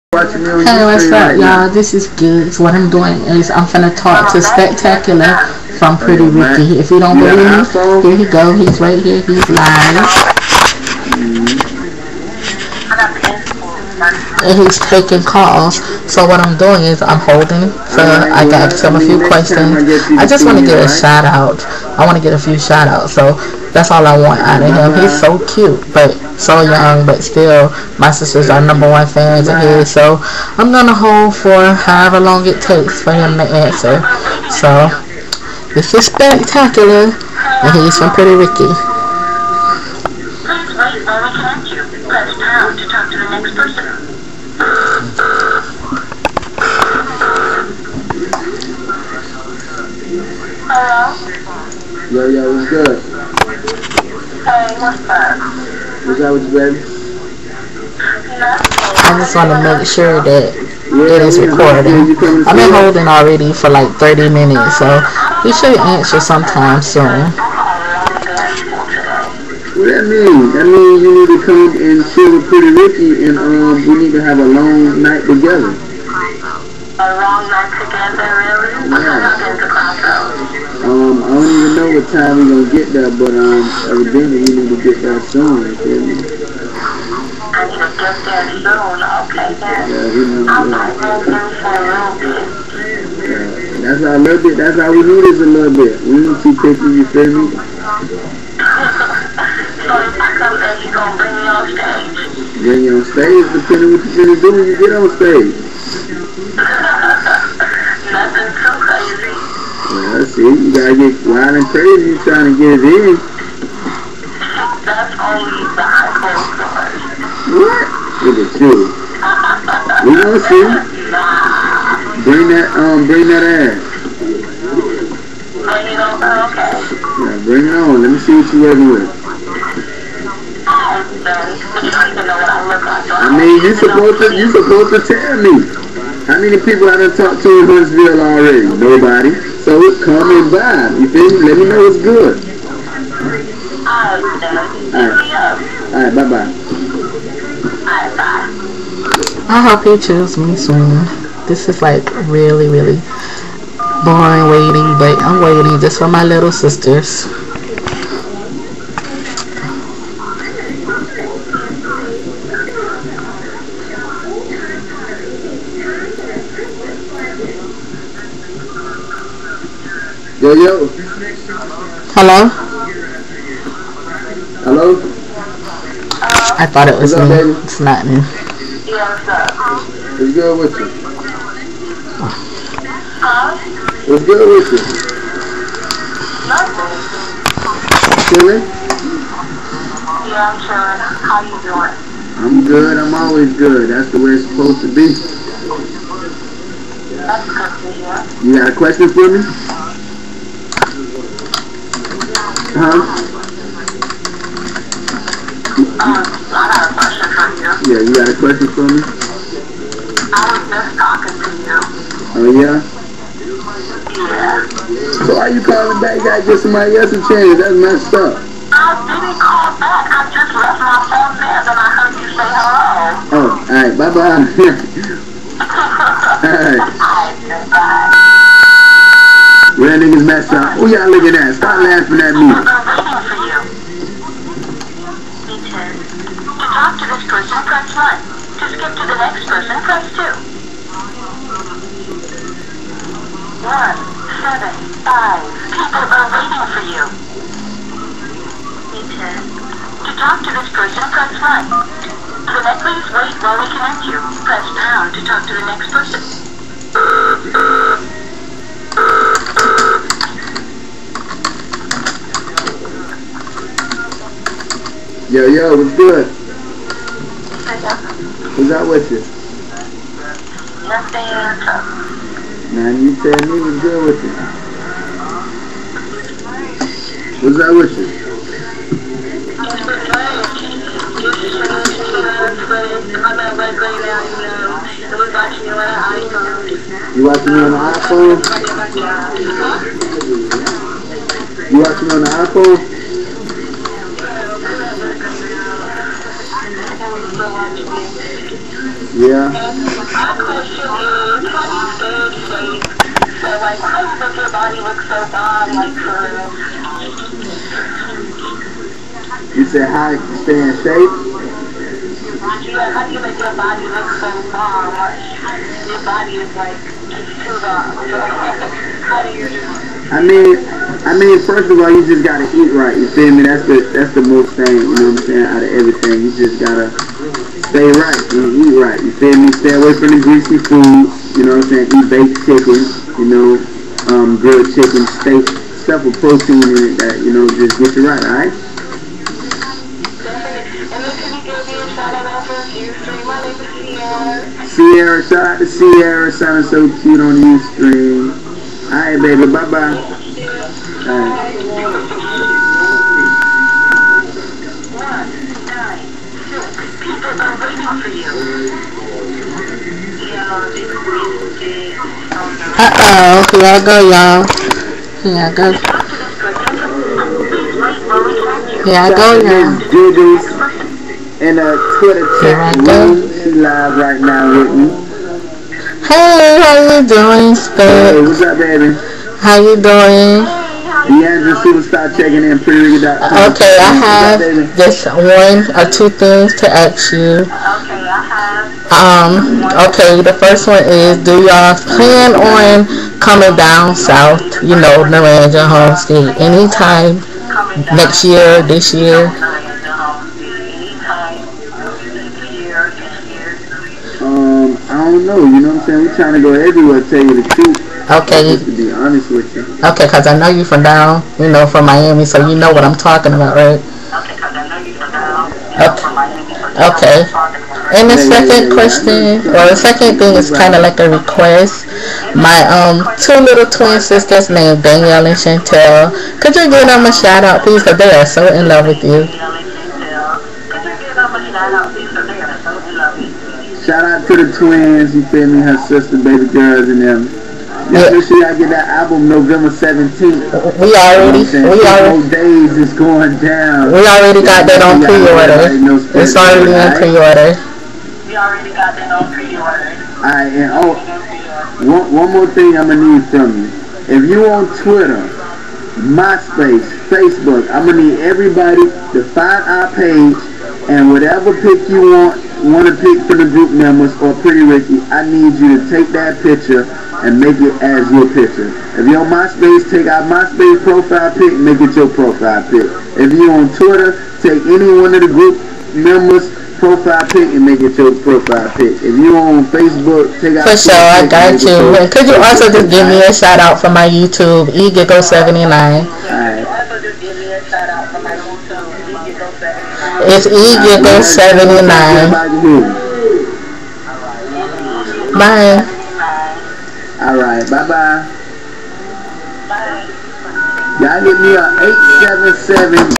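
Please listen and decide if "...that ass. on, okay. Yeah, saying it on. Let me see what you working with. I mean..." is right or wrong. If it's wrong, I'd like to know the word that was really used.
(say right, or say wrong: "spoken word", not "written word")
wrong: "bring", not "saying".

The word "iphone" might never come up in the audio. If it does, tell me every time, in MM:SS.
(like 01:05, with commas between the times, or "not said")
01:55, 04:47, 04:52.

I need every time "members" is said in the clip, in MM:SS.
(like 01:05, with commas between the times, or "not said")
07:43, 07:55.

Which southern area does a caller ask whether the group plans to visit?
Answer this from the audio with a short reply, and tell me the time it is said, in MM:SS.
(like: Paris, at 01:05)
Naranja Homestead, at 06:35.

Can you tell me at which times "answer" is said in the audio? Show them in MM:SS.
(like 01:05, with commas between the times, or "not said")
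00:33, 01:05.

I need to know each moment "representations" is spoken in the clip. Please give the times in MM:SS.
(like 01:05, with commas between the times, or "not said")
not said.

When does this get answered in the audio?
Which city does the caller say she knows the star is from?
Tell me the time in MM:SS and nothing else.
06:51.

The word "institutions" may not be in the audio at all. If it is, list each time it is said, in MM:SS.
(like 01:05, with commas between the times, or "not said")
not said.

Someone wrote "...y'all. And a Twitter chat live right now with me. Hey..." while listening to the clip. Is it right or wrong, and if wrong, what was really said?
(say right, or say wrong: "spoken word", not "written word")
right.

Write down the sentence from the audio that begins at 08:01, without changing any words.
Your, could you also just give me a shout out for my YouTube, eGiggle79?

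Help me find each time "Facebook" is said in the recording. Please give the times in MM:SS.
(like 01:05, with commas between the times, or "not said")
07:37, 07:59.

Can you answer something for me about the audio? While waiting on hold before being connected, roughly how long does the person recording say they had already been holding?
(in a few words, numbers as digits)
30 minutes.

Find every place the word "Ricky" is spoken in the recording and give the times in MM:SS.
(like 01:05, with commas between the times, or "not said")
00:06, 00:38, 01:12, 07:44.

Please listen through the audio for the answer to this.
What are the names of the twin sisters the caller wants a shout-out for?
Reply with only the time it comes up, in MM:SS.
07:04.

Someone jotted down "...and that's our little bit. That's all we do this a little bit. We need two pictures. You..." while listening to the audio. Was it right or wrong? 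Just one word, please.
right.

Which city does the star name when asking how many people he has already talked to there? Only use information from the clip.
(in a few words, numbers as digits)
Huntsville.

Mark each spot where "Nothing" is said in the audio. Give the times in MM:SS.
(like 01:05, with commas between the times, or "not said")
01:48, 03:06, 04:30.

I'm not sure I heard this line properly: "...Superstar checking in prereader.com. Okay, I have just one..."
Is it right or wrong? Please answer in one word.
right.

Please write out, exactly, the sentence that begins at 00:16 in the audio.
So what I'm doing is I'm holding.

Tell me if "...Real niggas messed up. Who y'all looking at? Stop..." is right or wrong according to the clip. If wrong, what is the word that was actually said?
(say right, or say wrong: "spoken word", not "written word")
right.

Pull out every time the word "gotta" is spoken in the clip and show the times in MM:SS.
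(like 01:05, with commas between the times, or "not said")
01:50, 03:36, 05:22, 05:26.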